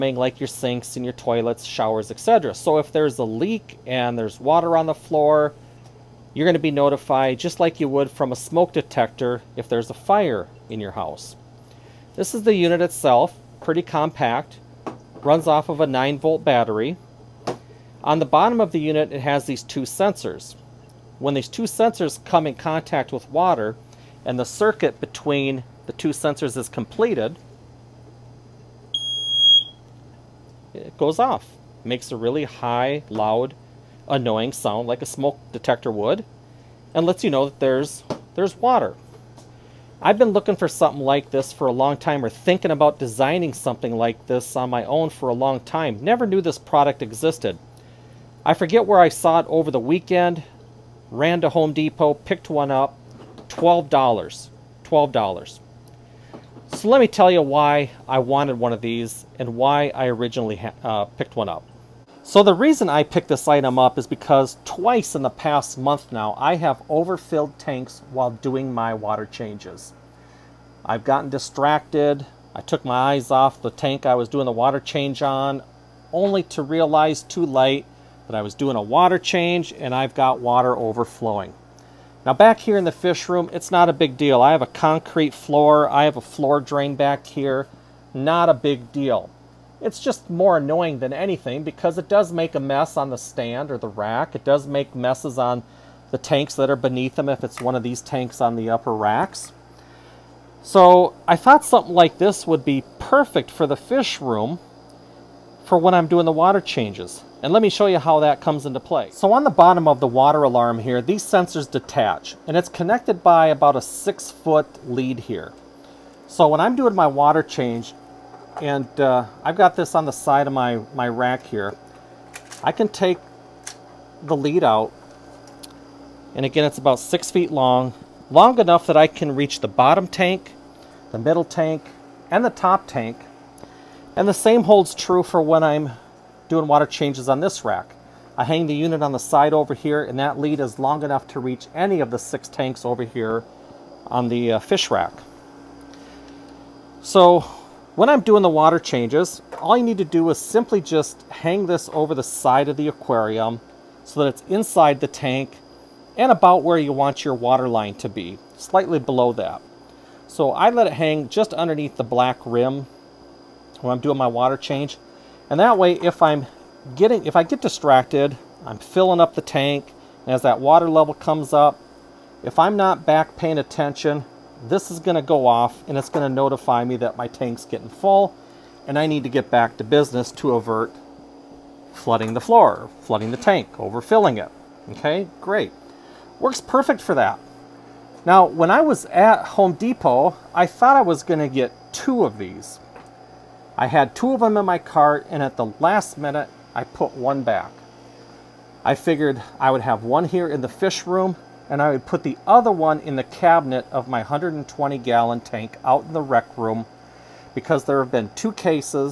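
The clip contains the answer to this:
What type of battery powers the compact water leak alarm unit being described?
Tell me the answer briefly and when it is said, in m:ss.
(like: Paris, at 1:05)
9 volt, at 0:15.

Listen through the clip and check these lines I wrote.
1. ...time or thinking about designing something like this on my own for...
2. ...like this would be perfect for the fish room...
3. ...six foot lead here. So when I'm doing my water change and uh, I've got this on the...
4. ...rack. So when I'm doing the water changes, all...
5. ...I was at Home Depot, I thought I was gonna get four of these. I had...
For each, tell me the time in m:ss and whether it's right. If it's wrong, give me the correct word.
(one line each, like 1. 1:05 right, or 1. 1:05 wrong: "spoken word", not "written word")
1. 0:41 right
2. 1:41 right
3. 1:53 right
4. 2:24 right
5. 3:08 wrong: "two", not "four".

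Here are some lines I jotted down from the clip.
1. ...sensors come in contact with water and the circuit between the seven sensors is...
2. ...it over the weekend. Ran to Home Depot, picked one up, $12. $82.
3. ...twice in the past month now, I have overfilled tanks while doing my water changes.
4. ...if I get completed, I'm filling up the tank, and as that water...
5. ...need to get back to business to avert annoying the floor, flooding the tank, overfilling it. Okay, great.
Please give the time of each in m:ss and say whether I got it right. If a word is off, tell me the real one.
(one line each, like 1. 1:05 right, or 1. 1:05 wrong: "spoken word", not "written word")
1. 0:21 wrong: "two", not "seven"
2. 0:49 wrong: "12", not "82"
3. 1:04 right
4. 2:47 wrong: "distracted", not "completed"
5. 2:59 wrong: "flooding", not "annoying".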